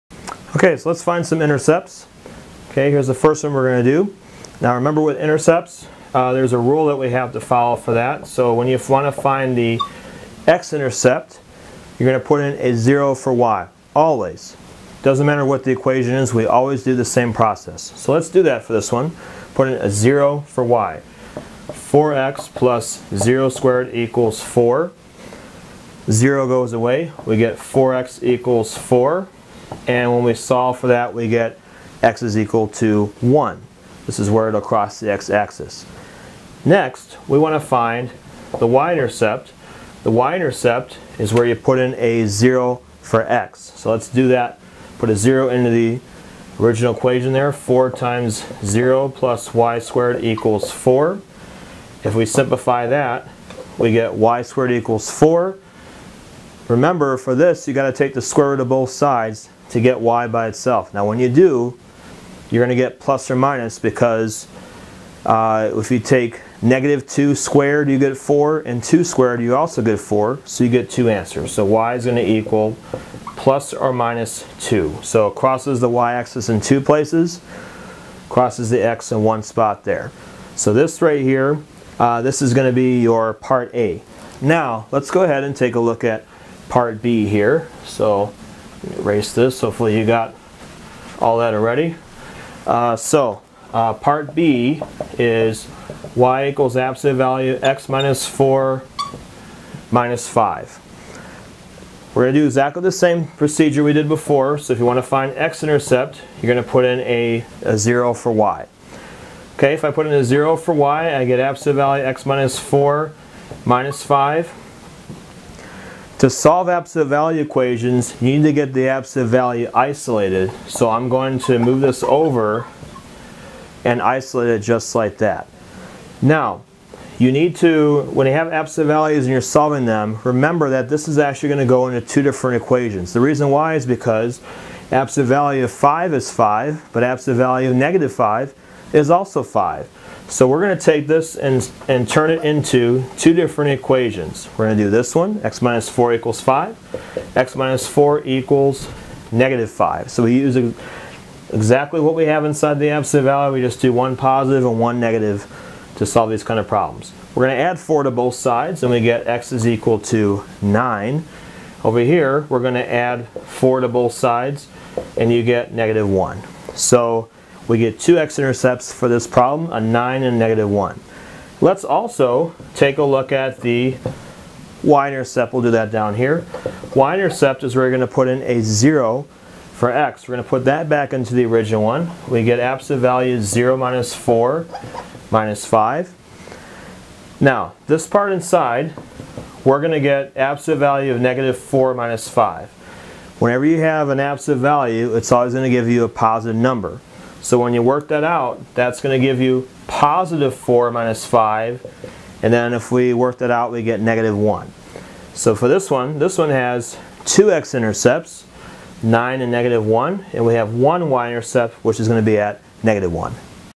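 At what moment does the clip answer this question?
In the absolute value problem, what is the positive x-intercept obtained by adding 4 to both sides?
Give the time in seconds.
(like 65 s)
159 s.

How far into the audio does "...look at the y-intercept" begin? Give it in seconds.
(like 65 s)
173 s.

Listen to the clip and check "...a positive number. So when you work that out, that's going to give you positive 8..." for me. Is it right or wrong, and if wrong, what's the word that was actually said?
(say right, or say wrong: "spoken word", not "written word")
wrong: "4", not "8".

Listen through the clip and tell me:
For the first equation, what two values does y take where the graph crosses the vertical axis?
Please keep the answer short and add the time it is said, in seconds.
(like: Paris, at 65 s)
plus or minus 2, at 73 s.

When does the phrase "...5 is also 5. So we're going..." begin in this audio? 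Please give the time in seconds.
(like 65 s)
138 s.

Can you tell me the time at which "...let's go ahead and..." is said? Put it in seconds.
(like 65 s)
84 s.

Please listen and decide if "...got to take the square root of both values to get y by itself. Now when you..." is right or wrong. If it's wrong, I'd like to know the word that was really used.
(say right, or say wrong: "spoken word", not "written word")
wrong: "sides", not "values".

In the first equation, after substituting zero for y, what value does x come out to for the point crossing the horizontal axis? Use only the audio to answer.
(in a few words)
1.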